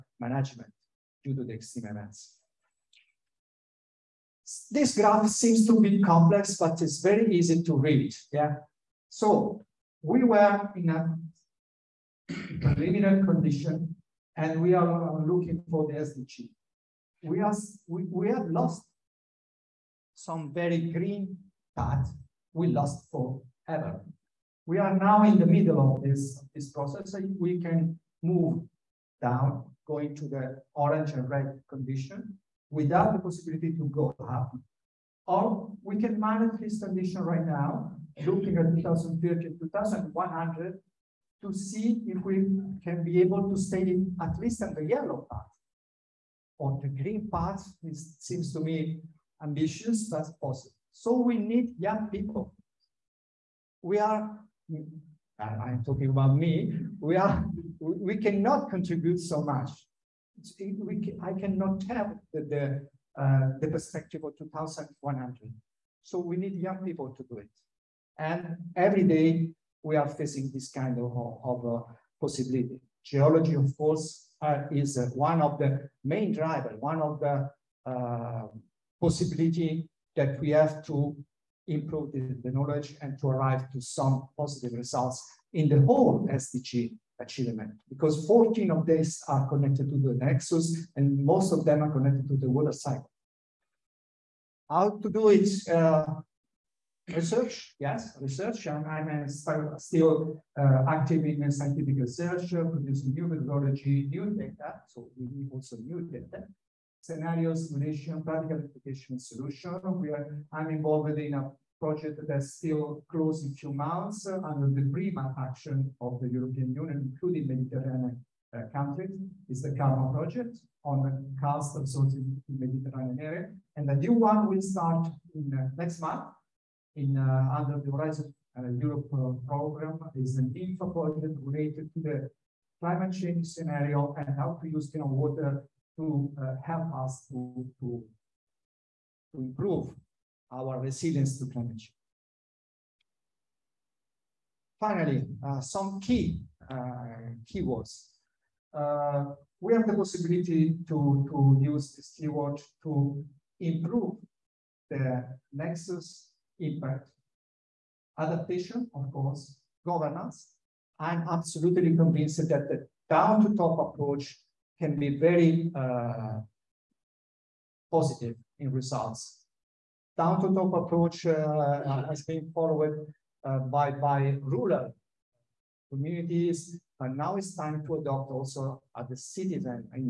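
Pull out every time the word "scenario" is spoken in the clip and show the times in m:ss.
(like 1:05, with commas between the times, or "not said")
1:47, 2:13.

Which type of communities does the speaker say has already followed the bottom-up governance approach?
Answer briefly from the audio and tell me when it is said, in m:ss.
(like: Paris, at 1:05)
Rural communities, at 2:54.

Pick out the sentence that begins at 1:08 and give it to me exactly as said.
And every day we are facing this kind of, of uh, possibility.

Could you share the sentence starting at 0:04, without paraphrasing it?
This graph seems to be complex, but it's very easy to read.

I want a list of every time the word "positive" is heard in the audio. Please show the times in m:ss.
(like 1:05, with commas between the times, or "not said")
1:24, 2:47.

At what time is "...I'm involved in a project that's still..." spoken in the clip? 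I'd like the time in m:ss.
1:50.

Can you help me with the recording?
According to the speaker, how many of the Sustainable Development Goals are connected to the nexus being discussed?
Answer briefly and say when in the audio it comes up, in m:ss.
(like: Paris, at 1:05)
14, at 1:28.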